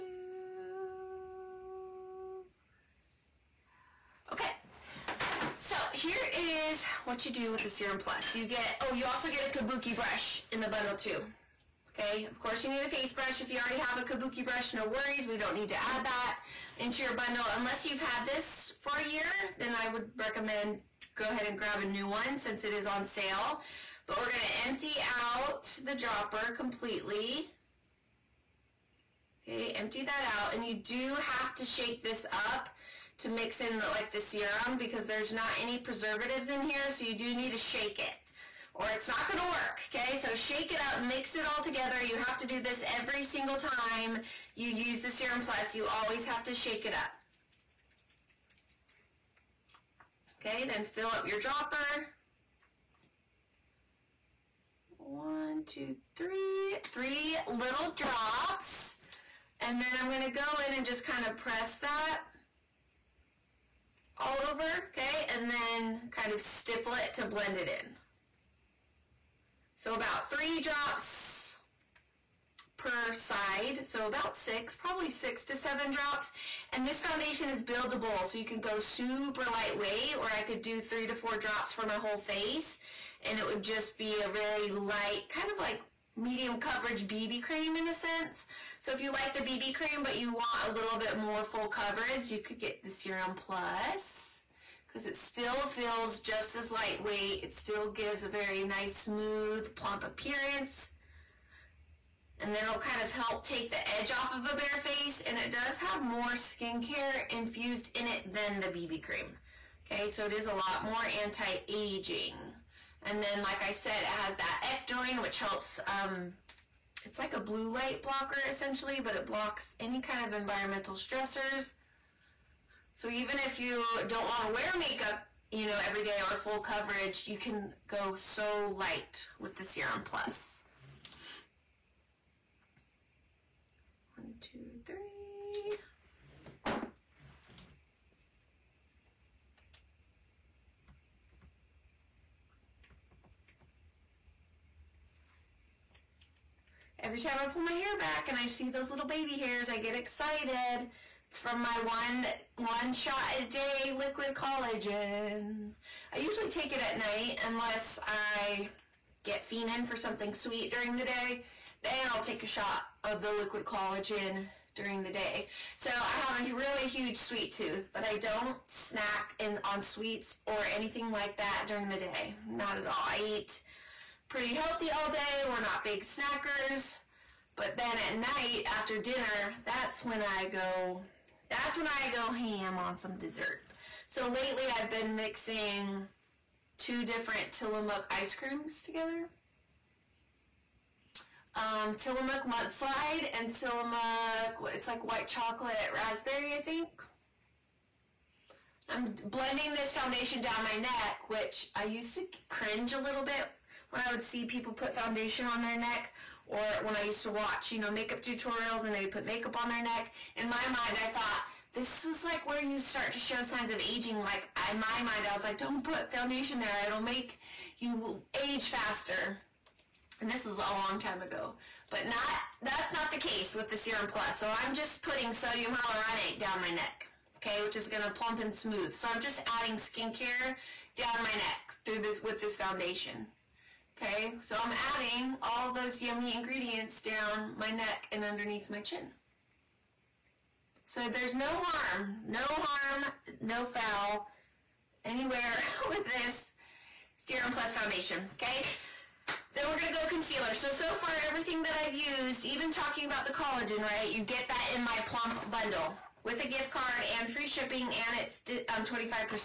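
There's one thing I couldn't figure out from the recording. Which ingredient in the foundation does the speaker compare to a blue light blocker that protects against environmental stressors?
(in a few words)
Ectoin.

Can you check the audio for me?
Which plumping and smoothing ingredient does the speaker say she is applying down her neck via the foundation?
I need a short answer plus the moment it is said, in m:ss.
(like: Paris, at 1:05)
Sodium hyaluronate, at 3:45.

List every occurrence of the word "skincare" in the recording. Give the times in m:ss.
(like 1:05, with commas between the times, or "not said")
1:46, 3:49.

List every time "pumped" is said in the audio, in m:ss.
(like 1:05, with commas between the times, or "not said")
not said.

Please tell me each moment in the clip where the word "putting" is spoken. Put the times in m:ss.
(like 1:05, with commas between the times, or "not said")
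3:45.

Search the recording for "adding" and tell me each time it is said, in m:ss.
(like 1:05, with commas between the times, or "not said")
3:49, 3:54.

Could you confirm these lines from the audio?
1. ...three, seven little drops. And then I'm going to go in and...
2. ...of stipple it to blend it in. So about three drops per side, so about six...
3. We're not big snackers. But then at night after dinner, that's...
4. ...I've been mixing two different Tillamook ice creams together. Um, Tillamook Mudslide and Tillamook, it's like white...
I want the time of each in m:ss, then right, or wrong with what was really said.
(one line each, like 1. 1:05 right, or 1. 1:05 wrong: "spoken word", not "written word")
1. 0:56 wrong: "three", not "seven"
2. 1:06 right
3. 2:55 right
4. 3:04 right.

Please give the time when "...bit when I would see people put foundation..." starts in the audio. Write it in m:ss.
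3:23.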